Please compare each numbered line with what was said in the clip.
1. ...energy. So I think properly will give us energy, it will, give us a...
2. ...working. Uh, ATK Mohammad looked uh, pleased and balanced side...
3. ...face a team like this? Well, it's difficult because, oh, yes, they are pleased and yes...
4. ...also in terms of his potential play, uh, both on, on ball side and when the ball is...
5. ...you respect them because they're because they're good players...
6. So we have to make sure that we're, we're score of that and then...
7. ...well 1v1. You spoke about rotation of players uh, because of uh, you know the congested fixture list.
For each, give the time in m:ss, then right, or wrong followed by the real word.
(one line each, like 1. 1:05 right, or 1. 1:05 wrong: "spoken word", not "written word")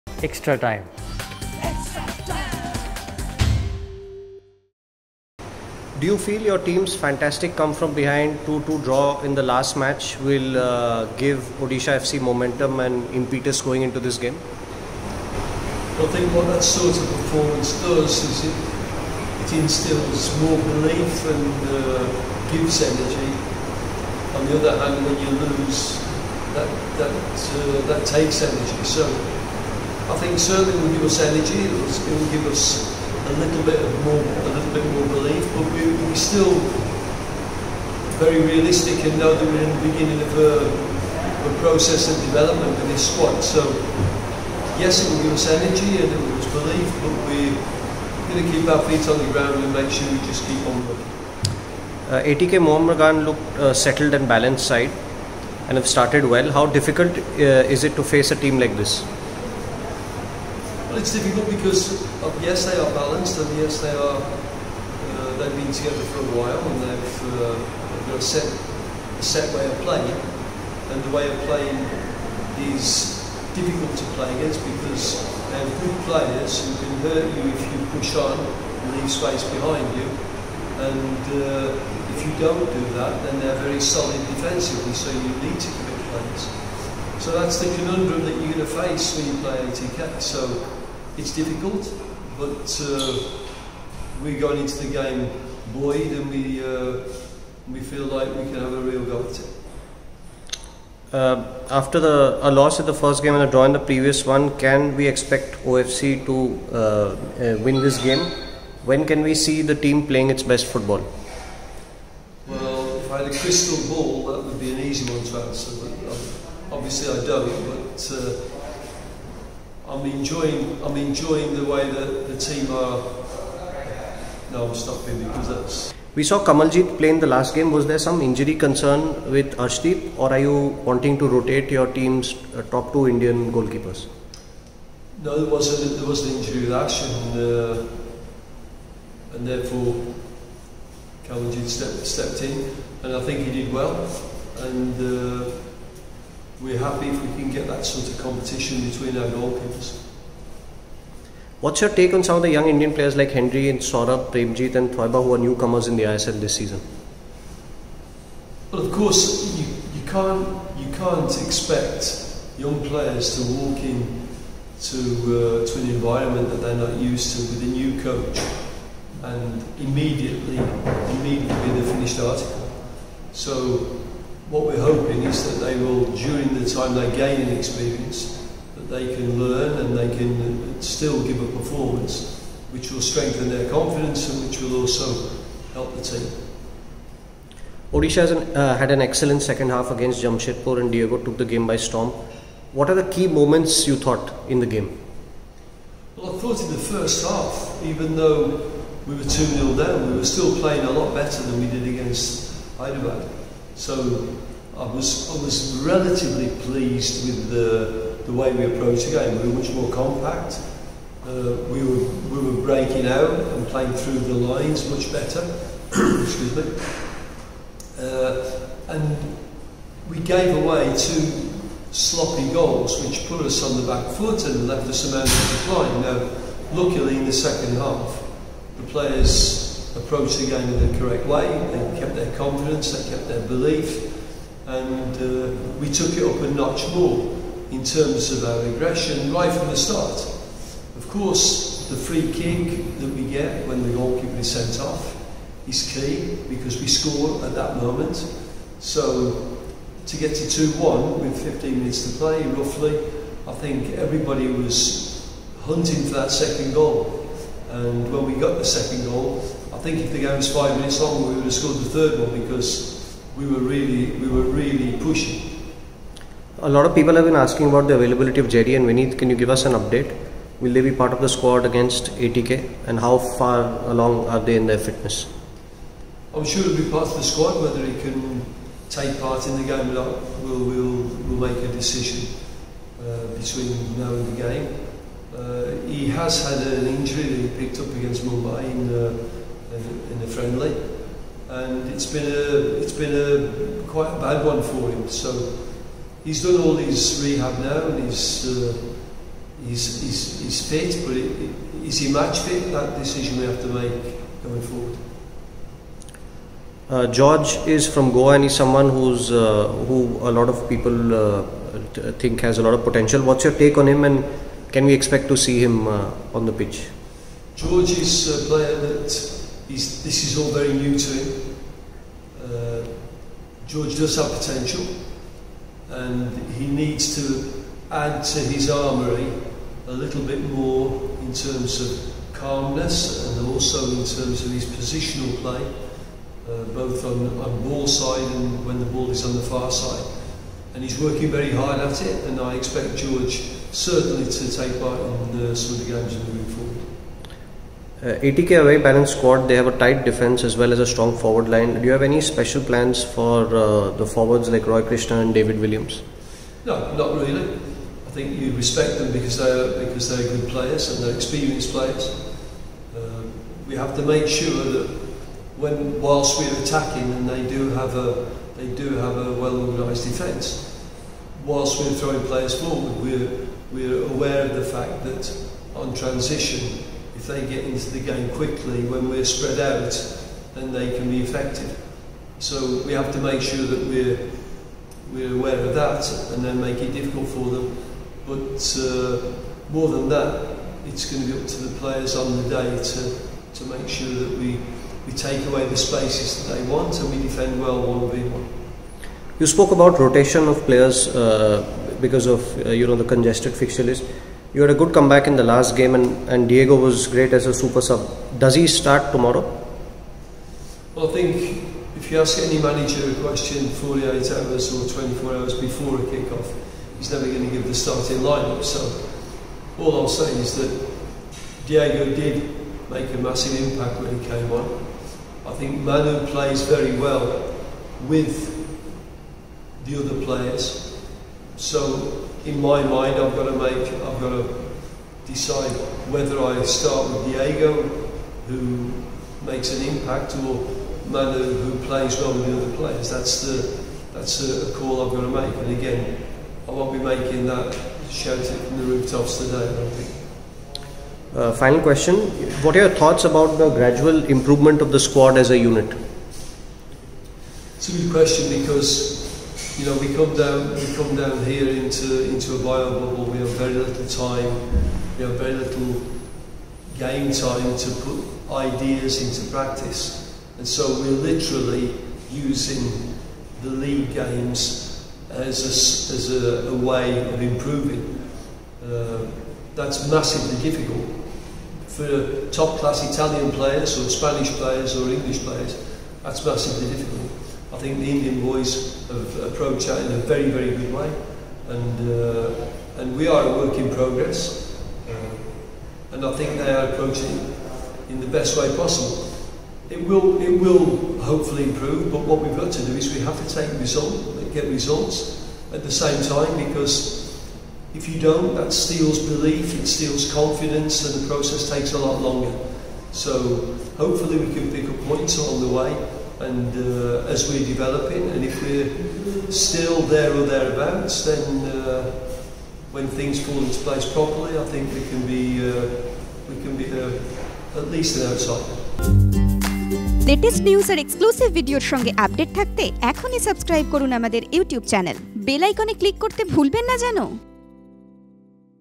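1. 0:28 wrong: "certainly", not "properly"
2. 0:50 wrong: "settled", not "pleased"
3. 0:58 wrong: "balanced", not "pleased"
4. 5:33 wrong: "positional", not "potential"
5. 5:58 right
6. 6:22 wrong: "aware", not "score"
7. 6:37 right.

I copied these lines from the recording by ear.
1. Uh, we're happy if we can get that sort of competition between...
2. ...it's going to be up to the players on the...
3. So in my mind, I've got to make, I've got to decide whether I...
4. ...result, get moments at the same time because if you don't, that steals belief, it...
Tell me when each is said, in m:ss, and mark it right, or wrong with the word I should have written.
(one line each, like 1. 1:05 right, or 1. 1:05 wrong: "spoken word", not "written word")
1. 2:25 right
2. 6:30 right
3. 7:11 right
4. 8:23 wrong: "results", not "moments".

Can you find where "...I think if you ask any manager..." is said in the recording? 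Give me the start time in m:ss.
6:51.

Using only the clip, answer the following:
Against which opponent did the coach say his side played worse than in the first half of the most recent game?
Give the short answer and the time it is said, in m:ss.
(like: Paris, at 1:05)
Hyderabad, at 3:22.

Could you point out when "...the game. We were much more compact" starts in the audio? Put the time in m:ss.
3:29.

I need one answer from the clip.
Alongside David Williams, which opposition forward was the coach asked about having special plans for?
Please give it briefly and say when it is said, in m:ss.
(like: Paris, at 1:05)
Roy Krishna, at 5:54.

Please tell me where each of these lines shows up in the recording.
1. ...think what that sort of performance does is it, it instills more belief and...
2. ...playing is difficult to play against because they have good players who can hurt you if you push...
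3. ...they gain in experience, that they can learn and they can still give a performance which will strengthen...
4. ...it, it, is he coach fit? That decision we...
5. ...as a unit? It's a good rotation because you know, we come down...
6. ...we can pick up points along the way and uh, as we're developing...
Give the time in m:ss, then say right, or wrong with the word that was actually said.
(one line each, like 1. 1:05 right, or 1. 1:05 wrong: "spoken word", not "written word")
1. 0:16 right
2. 1:11 right
3. 2:56 right
4. 5:01 wrong: "match", not "coach"
5. 7:35 wrong: "question", not "rotation"
6. 8:34 right.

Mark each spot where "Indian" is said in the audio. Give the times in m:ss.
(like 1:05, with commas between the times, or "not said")
2:13, 2:32, 8:08.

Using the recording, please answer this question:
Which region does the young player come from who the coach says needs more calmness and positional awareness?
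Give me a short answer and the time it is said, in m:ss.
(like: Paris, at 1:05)
Goa, at 5:08.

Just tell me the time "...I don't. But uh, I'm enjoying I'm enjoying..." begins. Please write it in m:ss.
1:57.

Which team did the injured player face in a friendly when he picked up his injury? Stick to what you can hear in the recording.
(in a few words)
Mumbai.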